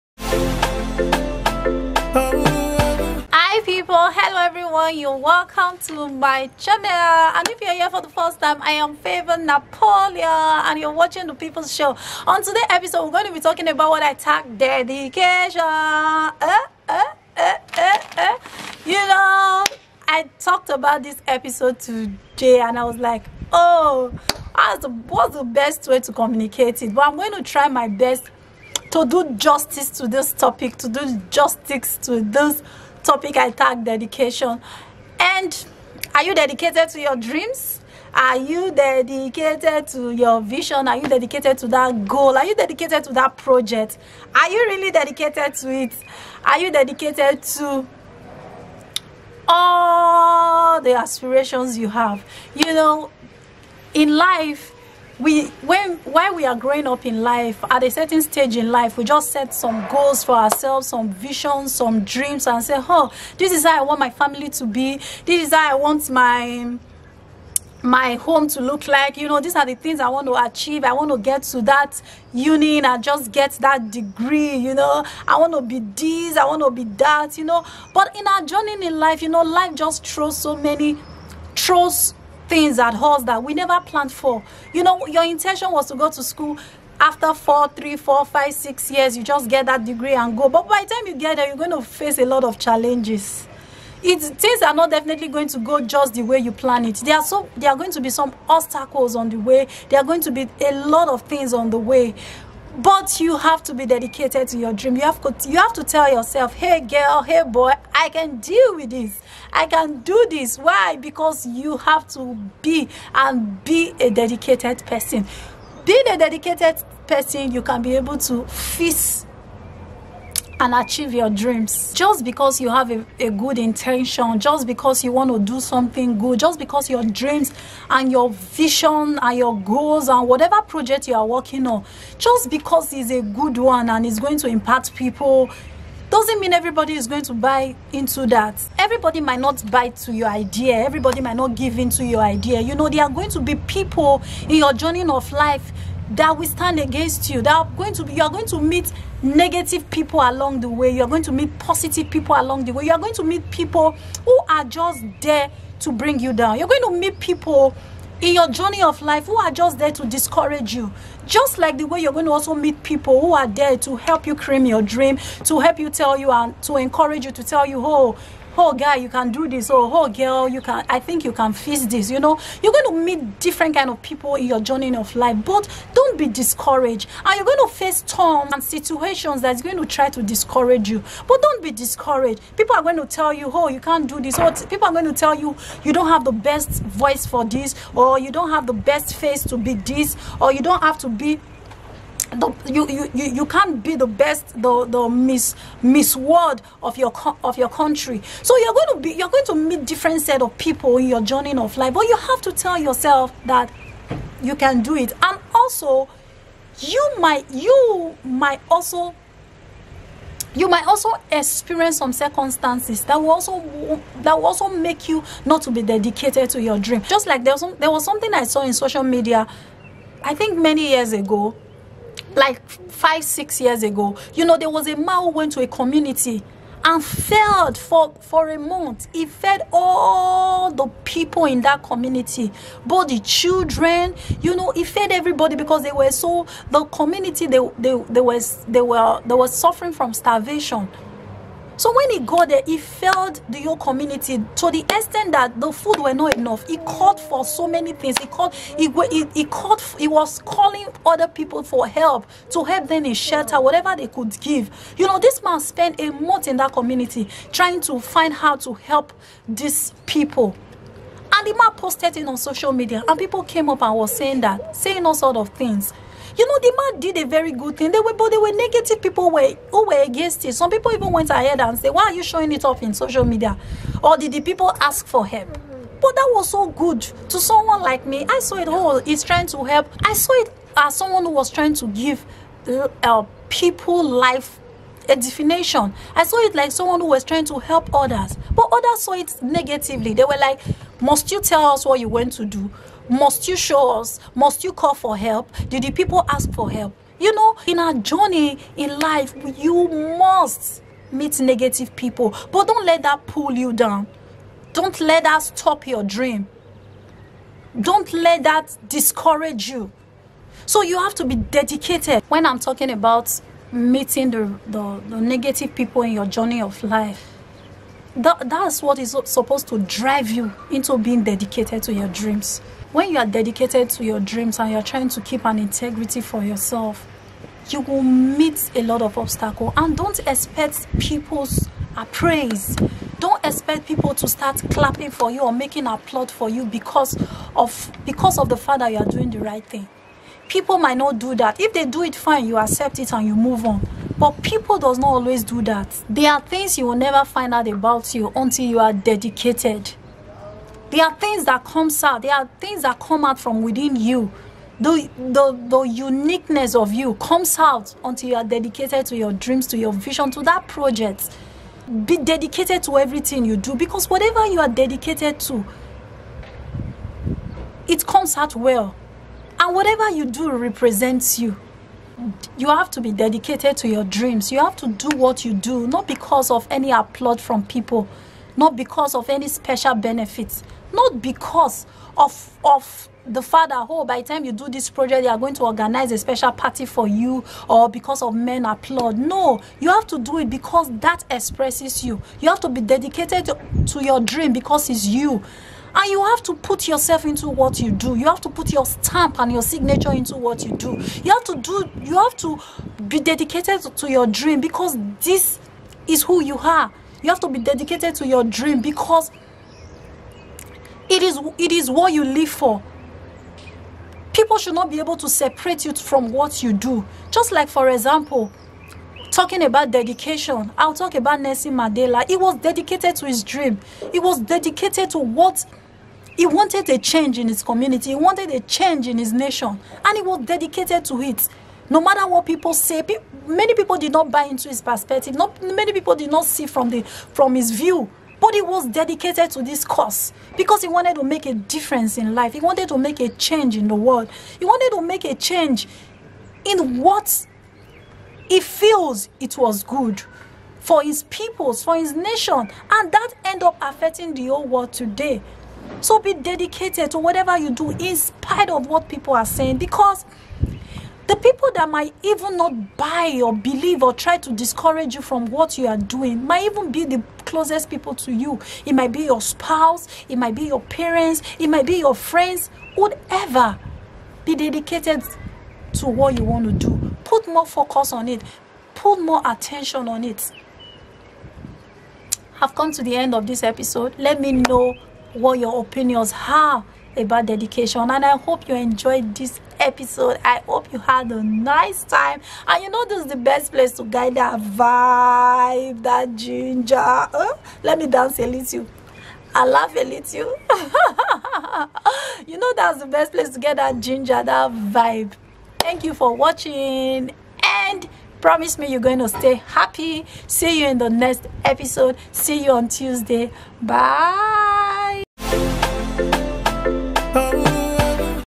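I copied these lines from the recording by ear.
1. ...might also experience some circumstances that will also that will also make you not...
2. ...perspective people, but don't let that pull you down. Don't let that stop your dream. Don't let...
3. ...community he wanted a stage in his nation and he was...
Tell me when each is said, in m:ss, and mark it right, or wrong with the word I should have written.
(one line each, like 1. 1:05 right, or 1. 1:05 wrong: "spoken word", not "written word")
1. 3:30 right
2. 5:01 wrong: "negative", not "perspective"
3. 7:07 wrong: "change", not "stage".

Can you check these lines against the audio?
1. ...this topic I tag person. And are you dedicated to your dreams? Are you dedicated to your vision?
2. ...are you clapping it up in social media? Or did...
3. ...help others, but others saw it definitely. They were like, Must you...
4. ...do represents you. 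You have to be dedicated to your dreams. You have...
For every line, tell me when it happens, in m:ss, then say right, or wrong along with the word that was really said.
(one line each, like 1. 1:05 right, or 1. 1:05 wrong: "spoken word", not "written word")
1. 0:32 wrong: "dedication", not "person"
2. 4:32 wrong: "showing", not "clapping"
3. 4:47 wrong: "negatively", not "definitely"
4. 6:10 right.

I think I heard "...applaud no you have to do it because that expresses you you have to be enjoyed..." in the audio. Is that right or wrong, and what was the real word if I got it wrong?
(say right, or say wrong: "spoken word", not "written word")
wrong: "dedicated", not "enjoyed".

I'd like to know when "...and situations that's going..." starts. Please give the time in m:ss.
2:58.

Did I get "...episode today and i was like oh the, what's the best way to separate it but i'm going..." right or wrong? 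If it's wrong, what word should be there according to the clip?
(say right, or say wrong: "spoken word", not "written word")
wrong: "communicate", not "separate".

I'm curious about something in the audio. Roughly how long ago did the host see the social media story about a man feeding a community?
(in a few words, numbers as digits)
5 or 6 years.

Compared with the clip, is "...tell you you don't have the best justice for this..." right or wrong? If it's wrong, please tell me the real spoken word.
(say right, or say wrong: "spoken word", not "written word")
wrong: "voice", not "justice".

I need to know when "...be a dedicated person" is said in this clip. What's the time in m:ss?
1:53.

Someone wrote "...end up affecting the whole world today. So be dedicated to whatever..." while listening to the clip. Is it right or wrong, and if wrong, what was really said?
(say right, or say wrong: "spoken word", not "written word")
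right.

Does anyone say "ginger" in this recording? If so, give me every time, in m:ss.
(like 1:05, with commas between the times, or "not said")
8:16, 8:23.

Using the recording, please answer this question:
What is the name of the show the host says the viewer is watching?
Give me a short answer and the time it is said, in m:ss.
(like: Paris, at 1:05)
The People's Show, at 0:11.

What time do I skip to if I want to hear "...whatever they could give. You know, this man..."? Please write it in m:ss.
4:13.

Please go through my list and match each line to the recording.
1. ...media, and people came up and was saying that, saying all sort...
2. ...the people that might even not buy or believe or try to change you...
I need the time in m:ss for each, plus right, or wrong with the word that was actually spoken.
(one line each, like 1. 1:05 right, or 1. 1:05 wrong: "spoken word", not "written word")
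1. 4:22 right
2. 7:41 wrong: "discourage", not "change".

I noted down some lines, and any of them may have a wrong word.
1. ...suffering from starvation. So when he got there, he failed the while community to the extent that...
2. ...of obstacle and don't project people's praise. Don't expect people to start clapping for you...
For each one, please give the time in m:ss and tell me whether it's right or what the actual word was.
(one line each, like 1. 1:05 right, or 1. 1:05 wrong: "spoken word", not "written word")
1. 3:59 wrong: "whole", not "while"
2. 5:29 wrong: "expect", not "project".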